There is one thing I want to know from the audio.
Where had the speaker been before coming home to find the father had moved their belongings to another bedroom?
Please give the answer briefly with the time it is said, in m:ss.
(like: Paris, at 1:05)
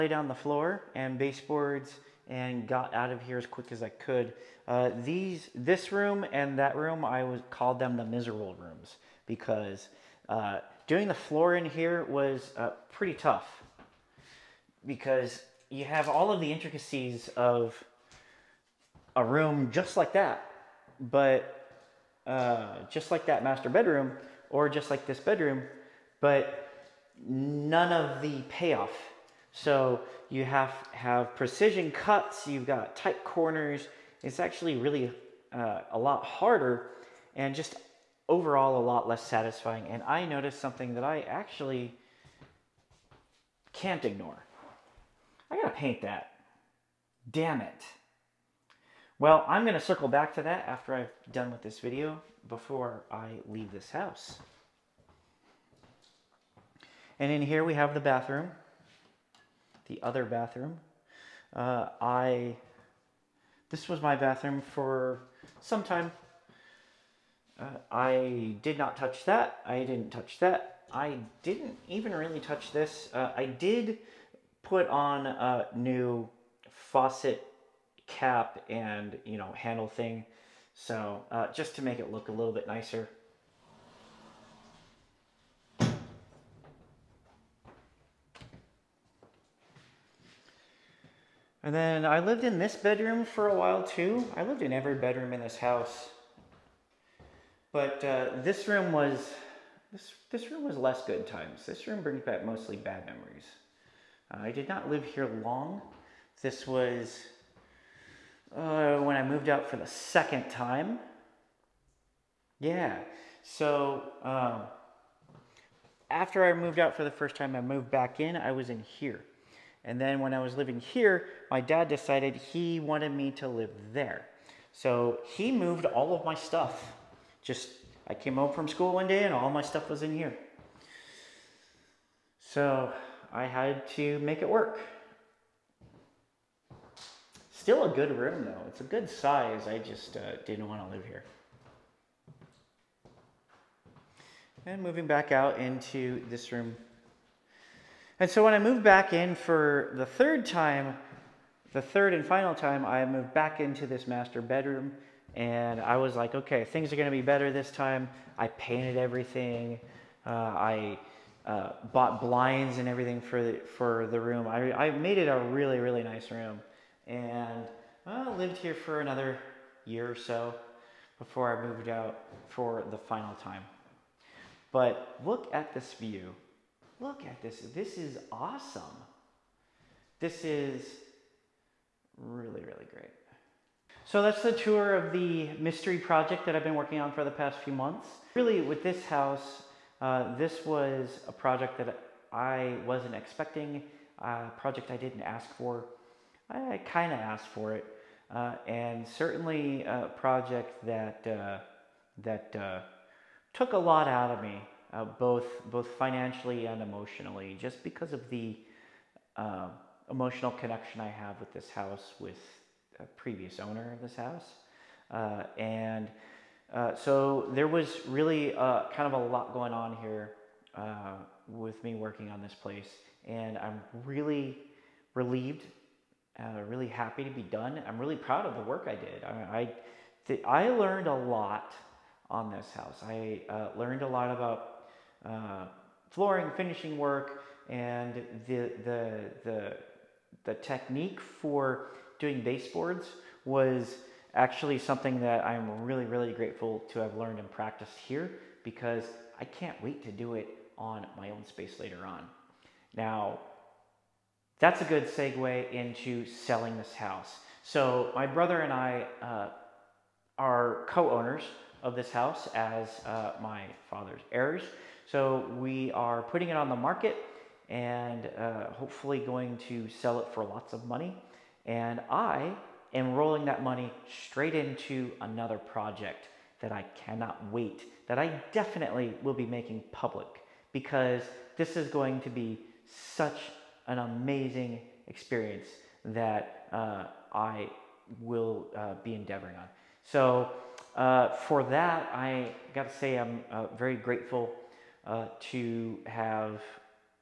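school, at 2:08.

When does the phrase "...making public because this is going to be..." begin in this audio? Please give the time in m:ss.
4:39.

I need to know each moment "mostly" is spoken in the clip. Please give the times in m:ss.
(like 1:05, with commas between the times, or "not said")
1:42.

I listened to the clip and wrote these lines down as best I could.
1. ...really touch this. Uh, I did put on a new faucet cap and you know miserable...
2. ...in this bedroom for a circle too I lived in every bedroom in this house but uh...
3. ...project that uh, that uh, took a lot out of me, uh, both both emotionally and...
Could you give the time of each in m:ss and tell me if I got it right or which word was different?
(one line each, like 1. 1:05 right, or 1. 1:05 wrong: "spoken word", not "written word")
1. 1:12 wrong: "handle", not "miserable"
2. 1:32 wrong: "while", not "circle"
3. 3:20 wrong: "financially", not "emotionally".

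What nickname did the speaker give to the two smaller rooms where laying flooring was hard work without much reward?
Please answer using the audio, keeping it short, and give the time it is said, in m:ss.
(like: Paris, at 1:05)
the miserable rooms, at 0:07.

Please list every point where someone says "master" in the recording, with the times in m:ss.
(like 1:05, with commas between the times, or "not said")
0:23, 2:34.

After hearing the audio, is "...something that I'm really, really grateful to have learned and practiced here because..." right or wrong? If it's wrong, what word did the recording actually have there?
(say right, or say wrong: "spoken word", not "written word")
right.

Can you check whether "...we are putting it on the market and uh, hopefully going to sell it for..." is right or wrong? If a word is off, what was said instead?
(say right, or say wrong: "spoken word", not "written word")
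right.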